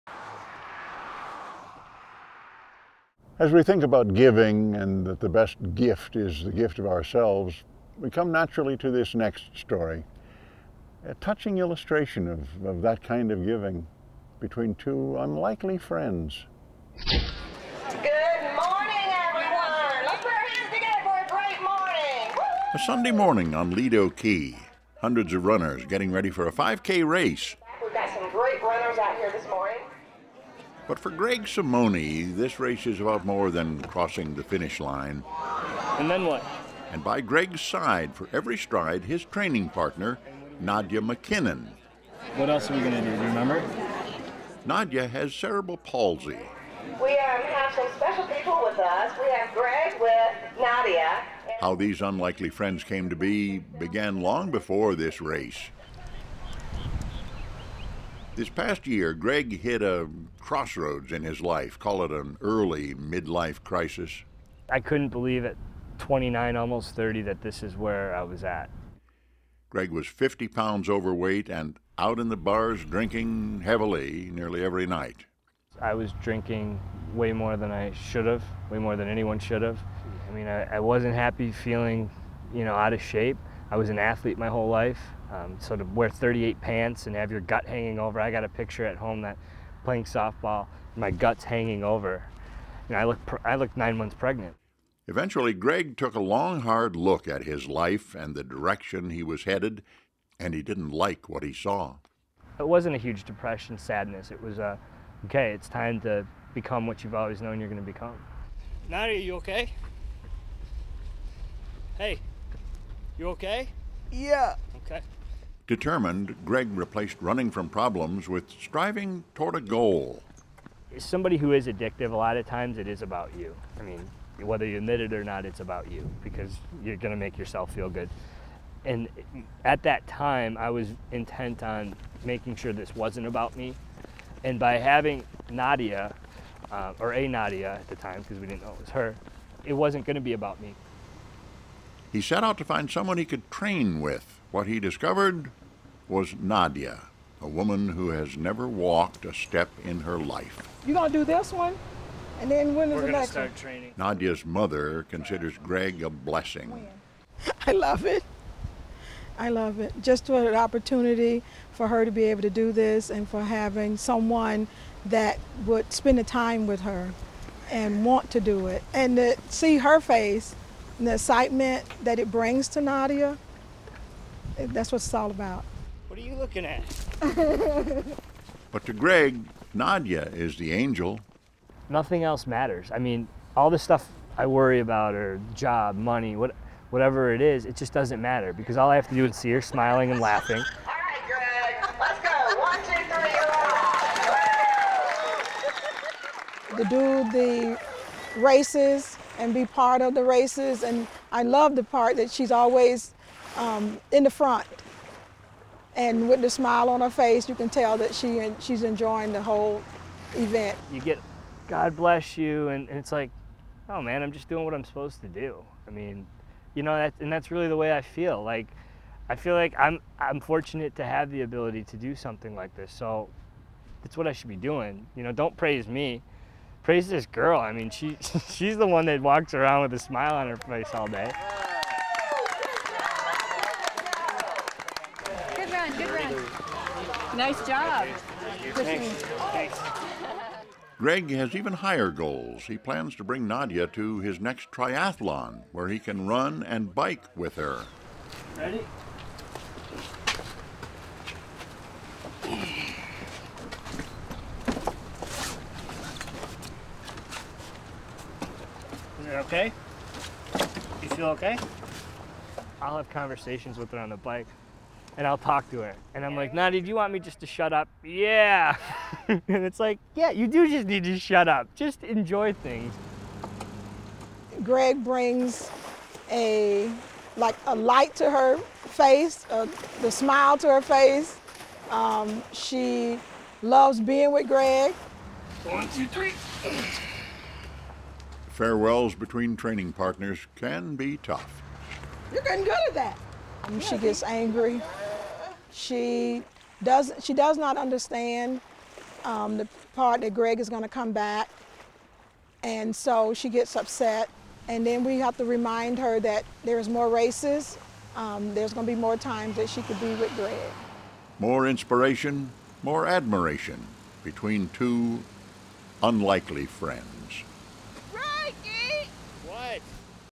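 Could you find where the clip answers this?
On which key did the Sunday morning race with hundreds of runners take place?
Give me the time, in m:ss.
0:23.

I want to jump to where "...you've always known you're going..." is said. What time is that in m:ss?
1:47.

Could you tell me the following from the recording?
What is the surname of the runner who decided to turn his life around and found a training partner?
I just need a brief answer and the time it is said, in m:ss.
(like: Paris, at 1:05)
Simony, at 0:31.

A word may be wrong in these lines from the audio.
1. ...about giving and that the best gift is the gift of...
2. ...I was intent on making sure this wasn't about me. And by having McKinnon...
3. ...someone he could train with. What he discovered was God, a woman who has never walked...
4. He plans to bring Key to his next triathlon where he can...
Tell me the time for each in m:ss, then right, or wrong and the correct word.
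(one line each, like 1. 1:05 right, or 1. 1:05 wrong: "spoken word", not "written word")
1. 0:03 right
2. 2:10 wrong: "Nadia", not "McKinnon"
3. 2:22 wrong: "Nadia", not "God"
4. 4:02 wrong: "Nadia", not "Key".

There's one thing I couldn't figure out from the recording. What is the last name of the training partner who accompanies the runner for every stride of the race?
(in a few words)
McKinnon.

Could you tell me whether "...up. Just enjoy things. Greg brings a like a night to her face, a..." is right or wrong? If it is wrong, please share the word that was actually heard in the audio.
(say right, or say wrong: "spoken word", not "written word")
wrong: "light", not "night".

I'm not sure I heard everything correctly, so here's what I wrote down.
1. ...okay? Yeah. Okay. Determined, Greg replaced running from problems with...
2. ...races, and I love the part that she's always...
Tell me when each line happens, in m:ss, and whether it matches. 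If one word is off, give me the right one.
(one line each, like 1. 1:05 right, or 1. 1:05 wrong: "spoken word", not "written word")
1. 1:53 right
2. 3:20 right.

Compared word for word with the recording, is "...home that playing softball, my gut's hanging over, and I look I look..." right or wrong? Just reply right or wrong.
right.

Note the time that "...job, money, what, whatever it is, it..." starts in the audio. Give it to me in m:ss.
3:05.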